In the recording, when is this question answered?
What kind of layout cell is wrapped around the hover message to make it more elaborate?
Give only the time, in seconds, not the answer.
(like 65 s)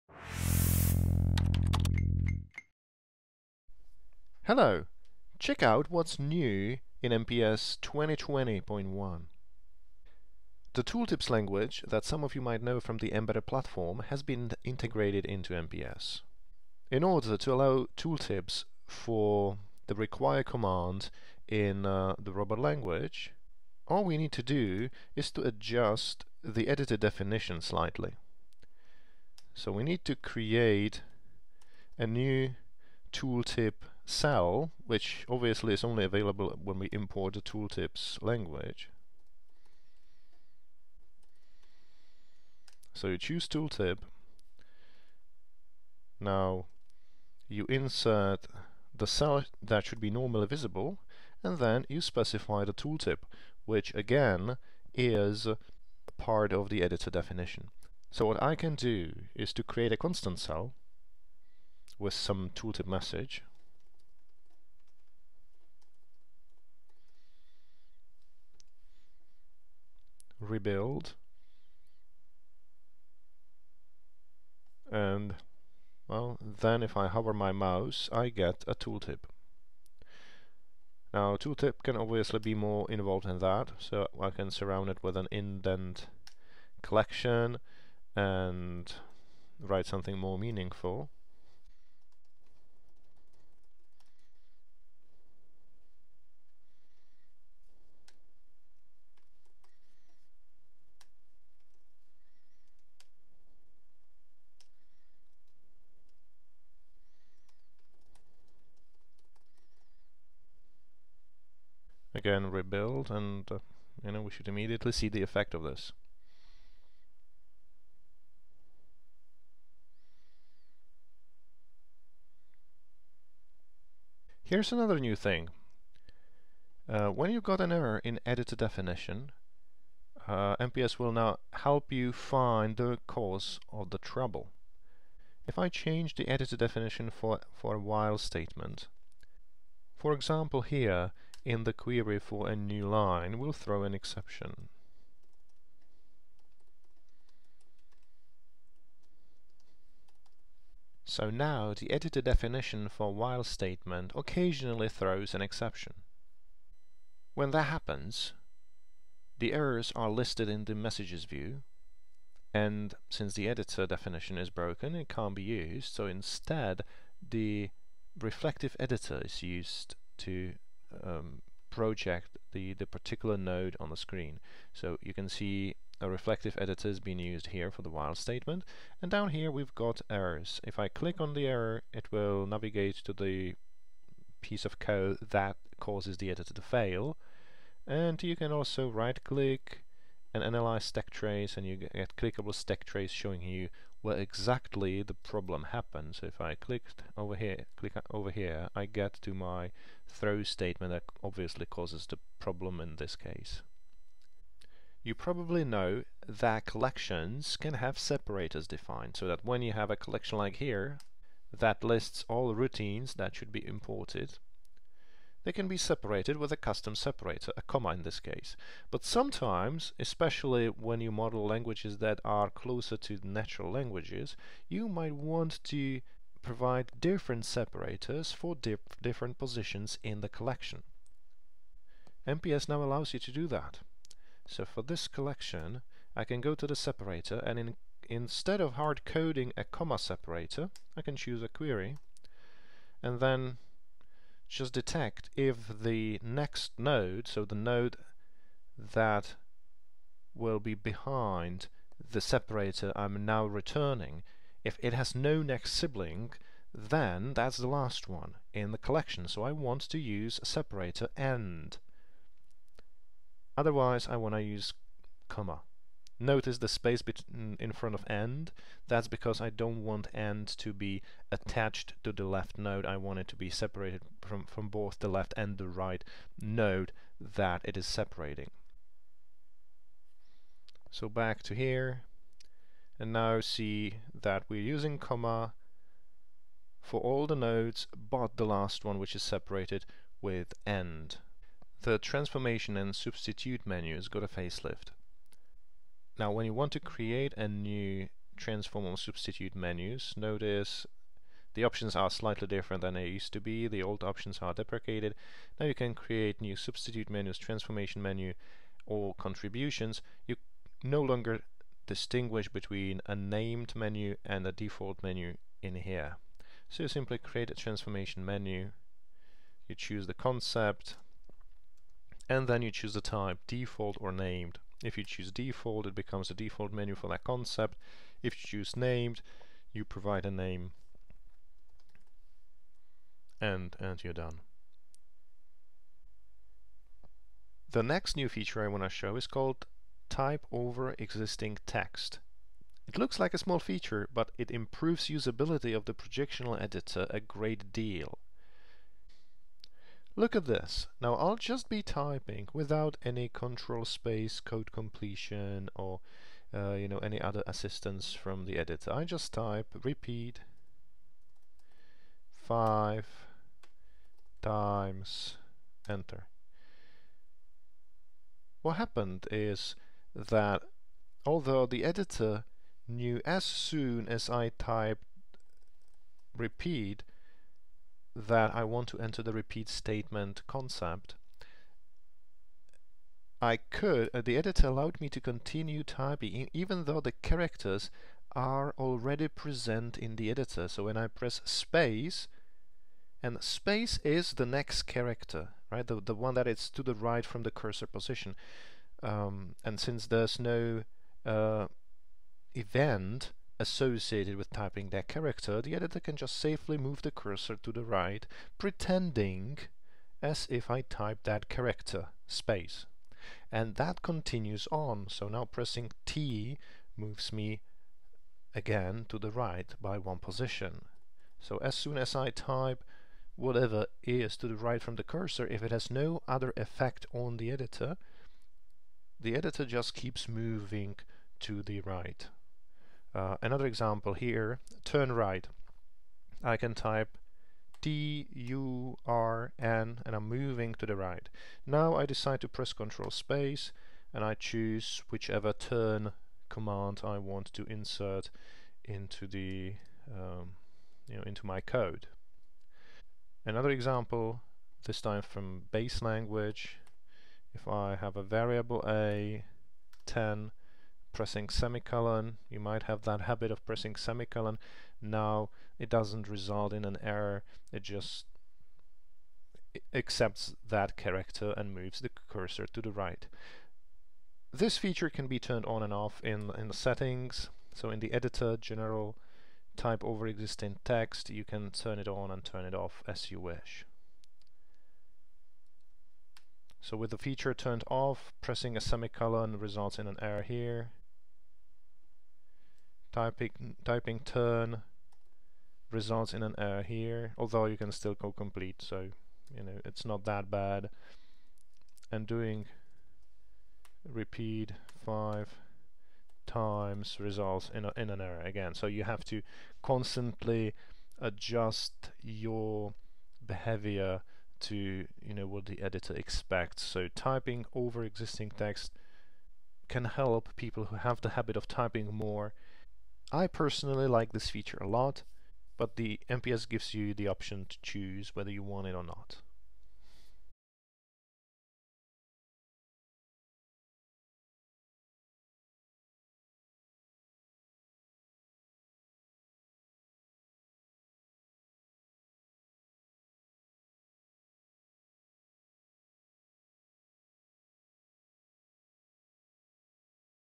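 85 s.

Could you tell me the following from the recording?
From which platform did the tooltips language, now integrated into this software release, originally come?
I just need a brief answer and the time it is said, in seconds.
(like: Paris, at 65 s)
mbeddr, at 13 s.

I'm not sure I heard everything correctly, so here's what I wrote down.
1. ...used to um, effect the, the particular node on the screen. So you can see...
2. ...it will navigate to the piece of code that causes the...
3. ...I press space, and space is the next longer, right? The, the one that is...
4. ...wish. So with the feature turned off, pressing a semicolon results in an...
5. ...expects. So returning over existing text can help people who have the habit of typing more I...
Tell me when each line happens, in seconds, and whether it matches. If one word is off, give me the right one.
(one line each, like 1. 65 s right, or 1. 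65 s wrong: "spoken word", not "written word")
1. 169 s wrong: "project", not "effect"
2. 181 s right
3. 390 s wrong: "character", not "longer"
4. 483 s right
5. 516 s wrong: "typing", not "returning".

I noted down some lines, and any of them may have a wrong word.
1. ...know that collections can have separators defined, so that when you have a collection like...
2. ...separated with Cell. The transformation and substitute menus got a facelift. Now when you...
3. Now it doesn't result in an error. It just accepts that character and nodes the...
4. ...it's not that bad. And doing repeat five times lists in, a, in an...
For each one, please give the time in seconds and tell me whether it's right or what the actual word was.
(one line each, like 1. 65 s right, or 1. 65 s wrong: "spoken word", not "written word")
1. 205 s right
2. 289 s wrong: "AND", not "Cell"
3. 465 s wrong: "moves", not "nodes"
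4. 499 s wrong: "results", not "lists".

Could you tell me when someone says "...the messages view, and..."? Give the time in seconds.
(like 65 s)
160 s.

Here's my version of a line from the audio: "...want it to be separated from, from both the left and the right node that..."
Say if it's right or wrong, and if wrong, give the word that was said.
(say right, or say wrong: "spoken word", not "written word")
right.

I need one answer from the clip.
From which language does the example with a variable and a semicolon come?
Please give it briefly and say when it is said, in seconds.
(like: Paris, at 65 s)
base language, at 455 s.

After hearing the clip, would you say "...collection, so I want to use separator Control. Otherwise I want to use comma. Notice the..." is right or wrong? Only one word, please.
wrong.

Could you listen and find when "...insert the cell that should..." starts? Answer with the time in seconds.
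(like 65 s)
47 s.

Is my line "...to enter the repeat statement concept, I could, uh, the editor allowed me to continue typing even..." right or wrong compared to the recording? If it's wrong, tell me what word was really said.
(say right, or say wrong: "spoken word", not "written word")
right.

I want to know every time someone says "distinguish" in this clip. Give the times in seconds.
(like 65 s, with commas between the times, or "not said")
311 s.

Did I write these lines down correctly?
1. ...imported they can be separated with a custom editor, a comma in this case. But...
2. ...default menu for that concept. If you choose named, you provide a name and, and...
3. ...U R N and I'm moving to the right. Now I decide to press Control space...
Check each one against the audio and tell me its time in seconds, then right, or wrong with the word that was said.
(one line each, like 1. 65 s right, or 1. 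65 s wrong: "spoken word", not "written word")
1. 213 s wrong: "separator", not "editor"
2. 326 s right
3. 438 s right.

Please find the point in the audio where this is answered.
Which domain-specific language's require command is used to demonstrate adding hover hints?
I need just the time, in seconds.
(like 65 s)
22 s.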